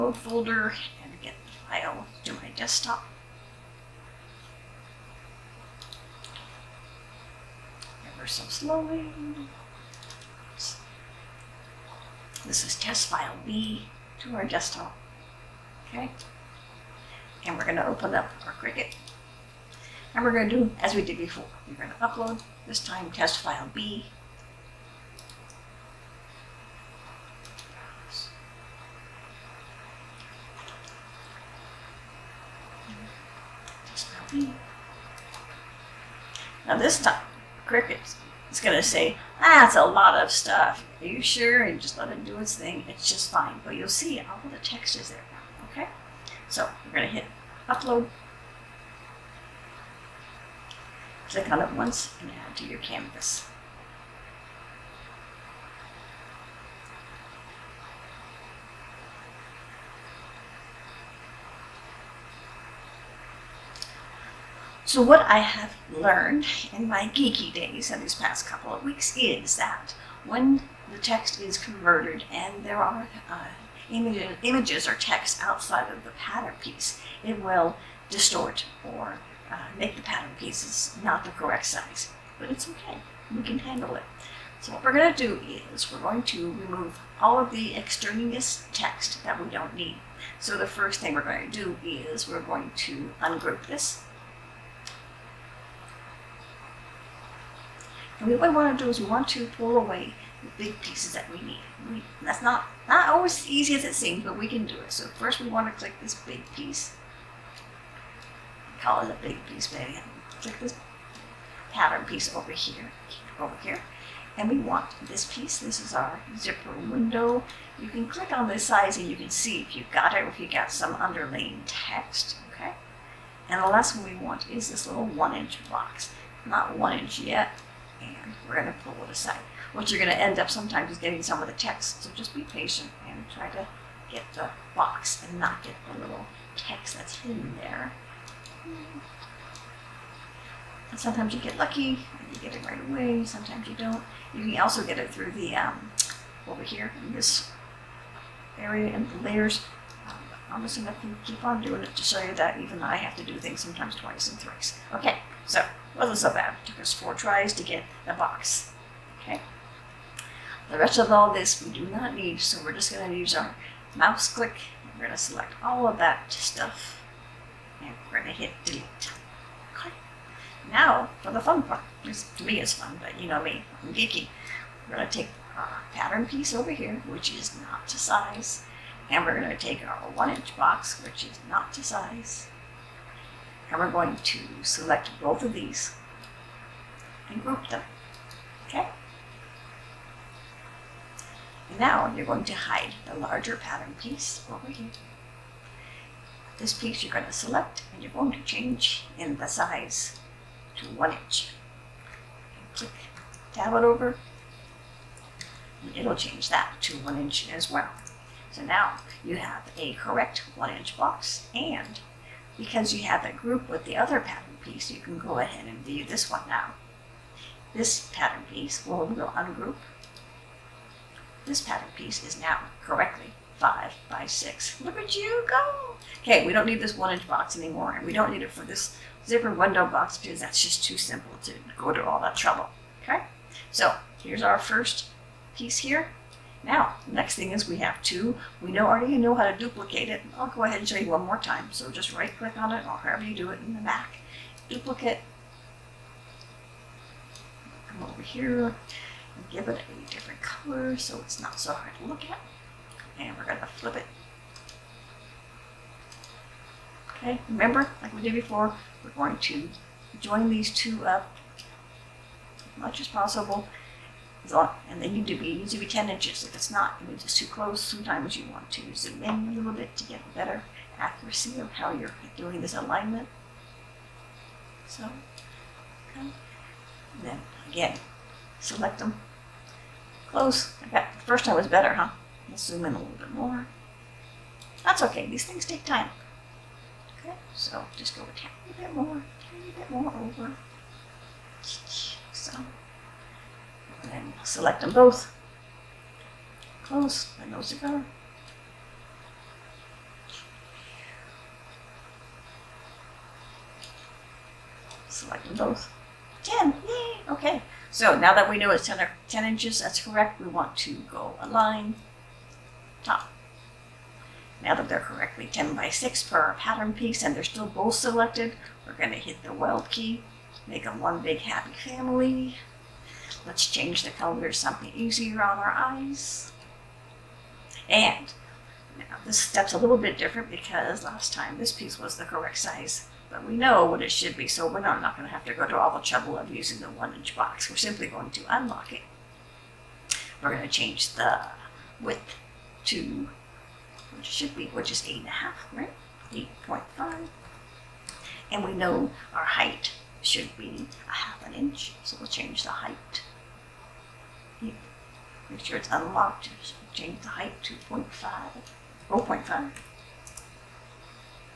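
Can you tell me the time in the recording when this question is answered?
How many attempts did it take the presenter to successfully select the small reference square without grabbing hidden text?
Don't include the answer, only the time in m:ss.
2:36.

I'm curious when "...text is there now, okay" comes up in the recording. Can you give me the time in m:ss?
0:44.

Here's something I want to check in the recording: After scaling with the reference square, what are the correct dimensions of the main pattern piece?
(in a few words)
5 by 6.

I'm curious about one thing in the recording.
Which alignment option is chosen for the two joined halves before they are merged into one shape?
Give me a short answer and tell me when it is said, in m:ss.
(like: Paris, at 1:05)
top, at 5:13.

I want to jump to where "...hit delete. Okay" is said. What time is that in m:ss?
2:48.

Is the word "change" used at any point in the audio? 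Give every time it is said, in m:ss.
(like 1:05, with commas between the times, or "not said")
3:18, 3:26, 5:23, 5:40, 5:52, 5:56.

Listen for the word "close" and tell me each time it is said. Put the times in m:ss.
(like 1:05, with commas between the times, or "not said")
4:27, 4:40, 4:56.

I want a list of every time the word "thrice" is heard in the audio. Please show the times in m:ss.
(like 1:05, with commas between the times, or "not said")
2:34.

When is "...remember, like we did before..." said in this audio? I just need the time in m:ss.
4:17.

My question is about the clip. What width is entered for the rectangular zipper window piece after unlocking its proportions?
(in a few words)
8.5.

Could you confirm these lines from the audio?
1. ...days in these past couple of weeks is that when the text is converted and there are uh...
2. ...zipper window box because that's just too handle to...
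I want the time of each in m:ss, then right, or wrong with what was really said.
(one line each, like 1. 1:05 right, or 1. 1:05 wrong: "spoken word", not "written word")
1. 1:07 right
2. 3:49 wrong: "simple", not "handle".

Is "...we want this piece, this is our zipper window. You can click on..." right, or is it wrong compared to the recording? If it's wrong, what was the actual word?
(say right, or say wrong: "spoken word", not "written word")
right.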